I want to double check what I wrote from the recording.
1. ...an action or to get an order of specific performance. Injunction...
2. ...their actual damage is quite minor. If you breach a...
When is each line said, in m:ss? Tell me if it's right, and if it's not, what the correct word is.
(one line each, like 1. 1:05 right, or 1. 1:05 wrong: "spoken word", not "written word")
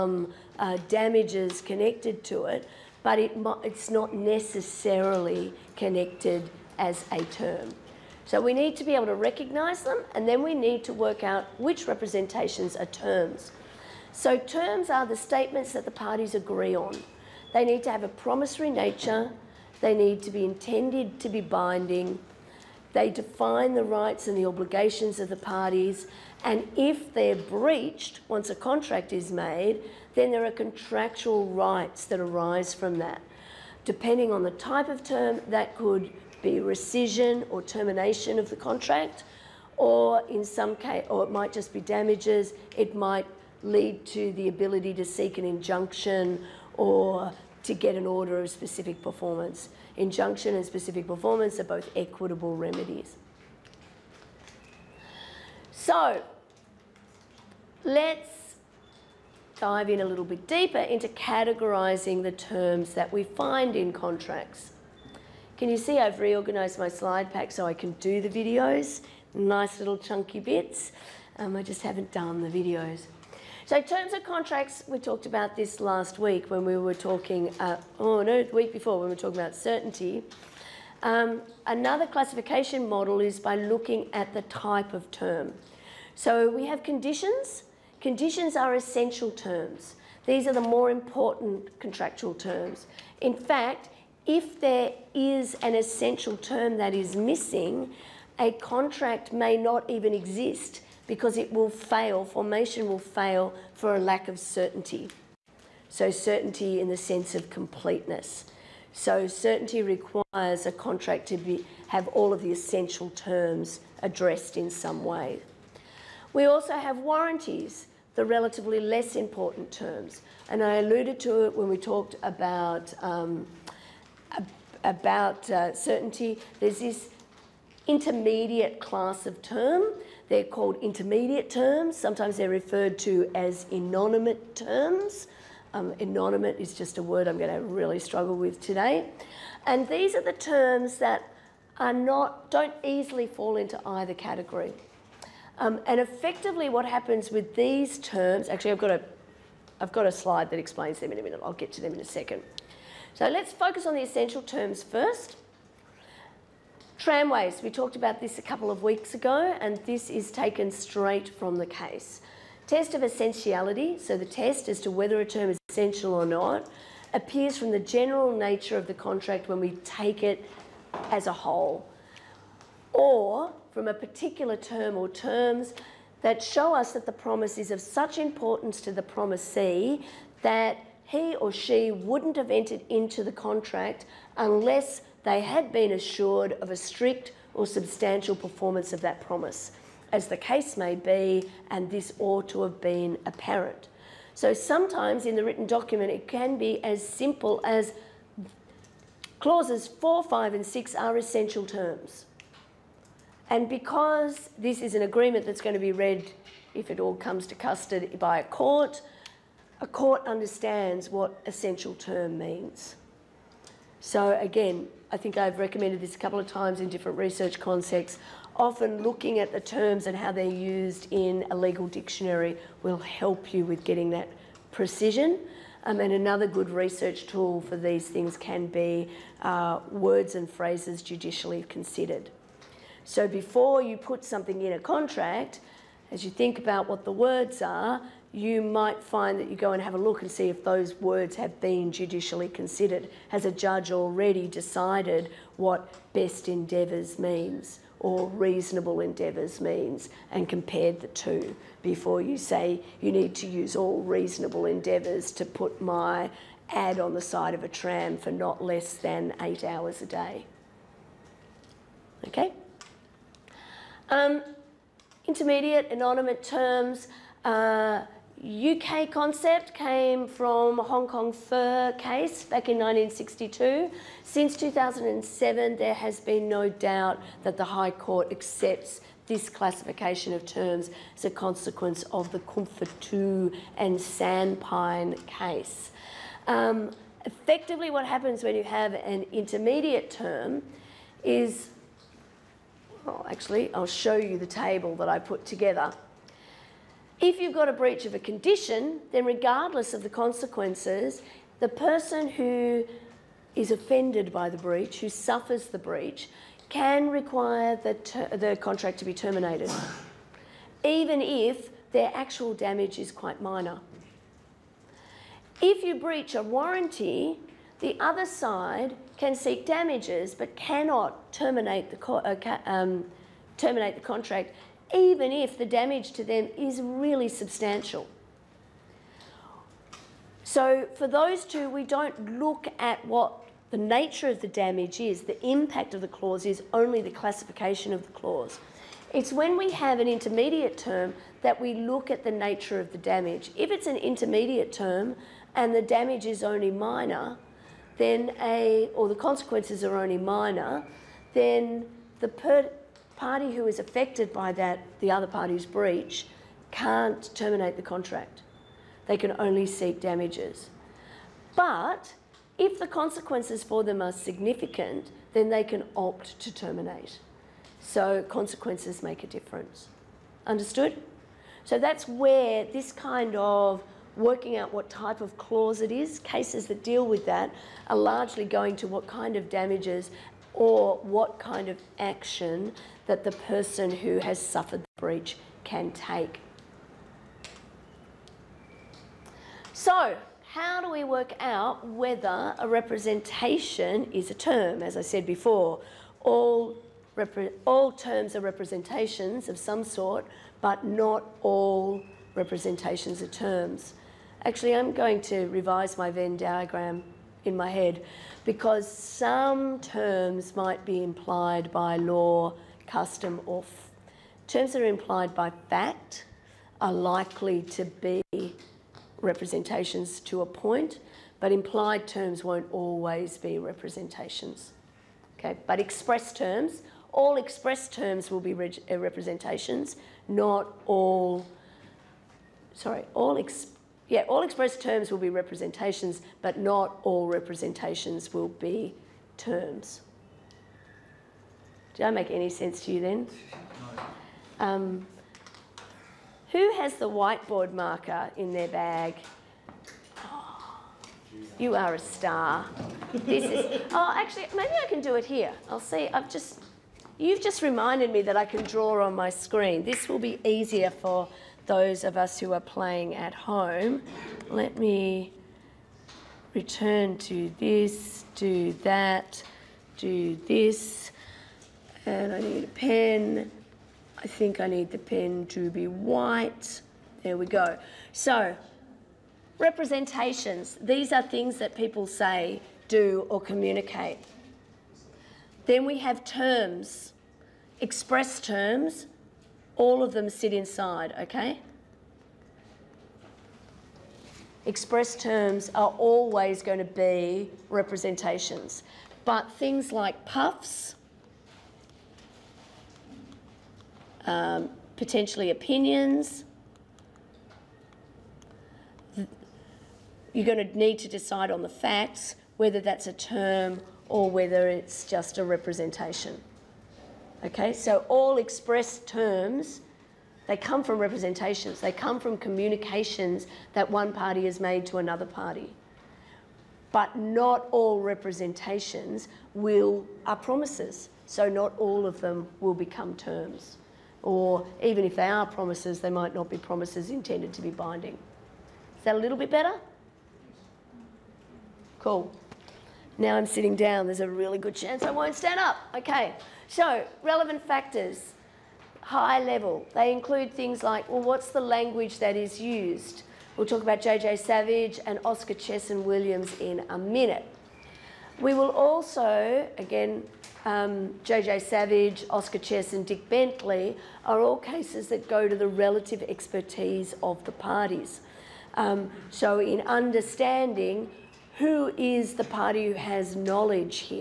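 1. 0:45 wrong: "injunction", not "action"
2. 5:11 right.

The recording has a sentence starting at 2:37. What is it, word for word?
Tramways, we talked about this a couple of weeks ago, and this is taken straight from the case.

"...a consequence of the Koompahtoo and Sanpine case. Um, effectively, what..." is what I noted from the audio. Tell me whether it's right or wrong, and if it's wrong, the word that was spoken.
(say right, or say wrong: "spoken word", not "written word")
right.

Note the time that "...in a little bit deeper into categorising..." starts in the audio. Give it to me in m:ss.
0:59.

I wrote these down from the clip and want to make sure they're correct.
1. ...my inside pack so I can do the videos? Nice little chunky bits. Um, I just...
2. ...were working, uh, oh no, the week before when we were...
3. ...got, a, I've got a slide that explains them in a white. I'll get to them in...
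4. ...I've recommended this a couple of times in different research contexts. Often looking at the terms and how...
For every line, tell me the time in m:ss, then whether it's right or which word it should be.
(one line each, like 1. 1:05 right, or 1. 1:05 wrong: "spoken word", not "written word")
1. 1:06 wrong: "slide", not "inside"
2. 1:16 wrong: "talking", not "working"
3. 2:28 wrong: "minute", not "white"
4. 3:35 right.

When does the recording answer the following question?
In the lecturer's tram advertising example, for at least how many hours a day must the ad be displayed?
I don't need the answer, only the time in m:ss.
4:19.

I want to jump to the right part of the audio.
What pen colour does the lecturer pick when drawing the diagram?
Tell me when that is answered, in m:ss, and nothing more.
7:55.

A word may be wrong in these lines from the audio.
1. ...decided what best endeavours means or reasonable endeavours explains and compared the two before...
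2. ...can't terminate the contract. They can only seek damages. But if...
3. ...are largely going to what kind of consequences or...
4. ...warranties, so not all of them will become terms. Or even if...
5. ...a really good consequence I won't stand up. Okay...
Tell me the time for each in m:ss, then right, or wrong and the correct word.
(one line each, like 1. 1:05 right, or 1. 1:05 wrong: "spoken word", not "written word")
1. 4:04 wrong: "means", not "explains"
2. 5:56 right
3. 6:17 wrong: "damages", not "consequences"
4. 8:50 wrong: "promises", not "warranties"
5. 9:04 wrong: "chance", not "consequence".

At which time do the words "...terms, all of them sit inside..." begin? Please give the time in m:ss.
8:08.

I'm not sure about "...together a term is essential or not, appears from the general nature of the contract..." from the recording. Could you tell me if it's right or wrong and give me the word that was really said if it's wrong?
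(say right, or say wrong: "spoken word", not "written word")
wrong: "whether", not "together".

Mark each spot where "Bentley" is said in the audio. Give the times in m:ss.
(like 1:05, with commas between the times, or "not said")
9:23.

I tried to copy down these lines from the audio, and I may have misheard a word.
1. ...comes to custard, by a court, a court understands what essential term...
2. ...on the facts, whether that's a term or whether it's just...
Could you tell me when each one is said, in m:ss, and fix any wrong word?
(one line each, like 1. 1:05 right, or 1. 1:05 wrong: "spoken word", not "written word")
1. 3:27 right
2. 8:31 right.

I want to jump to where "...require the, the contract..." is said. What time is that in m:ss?
5:07.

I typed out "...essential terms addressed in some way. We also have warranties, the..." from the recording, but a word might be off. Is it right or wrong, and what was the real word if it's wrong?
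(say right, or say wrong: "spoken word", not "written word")
right.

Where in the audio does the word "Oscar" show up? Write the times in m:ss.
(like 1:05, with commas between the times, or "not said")
9:15, 9:22.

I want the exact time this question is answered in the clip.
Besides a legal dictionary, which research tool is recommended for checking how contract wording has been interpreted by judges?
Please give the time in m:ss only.
3:49.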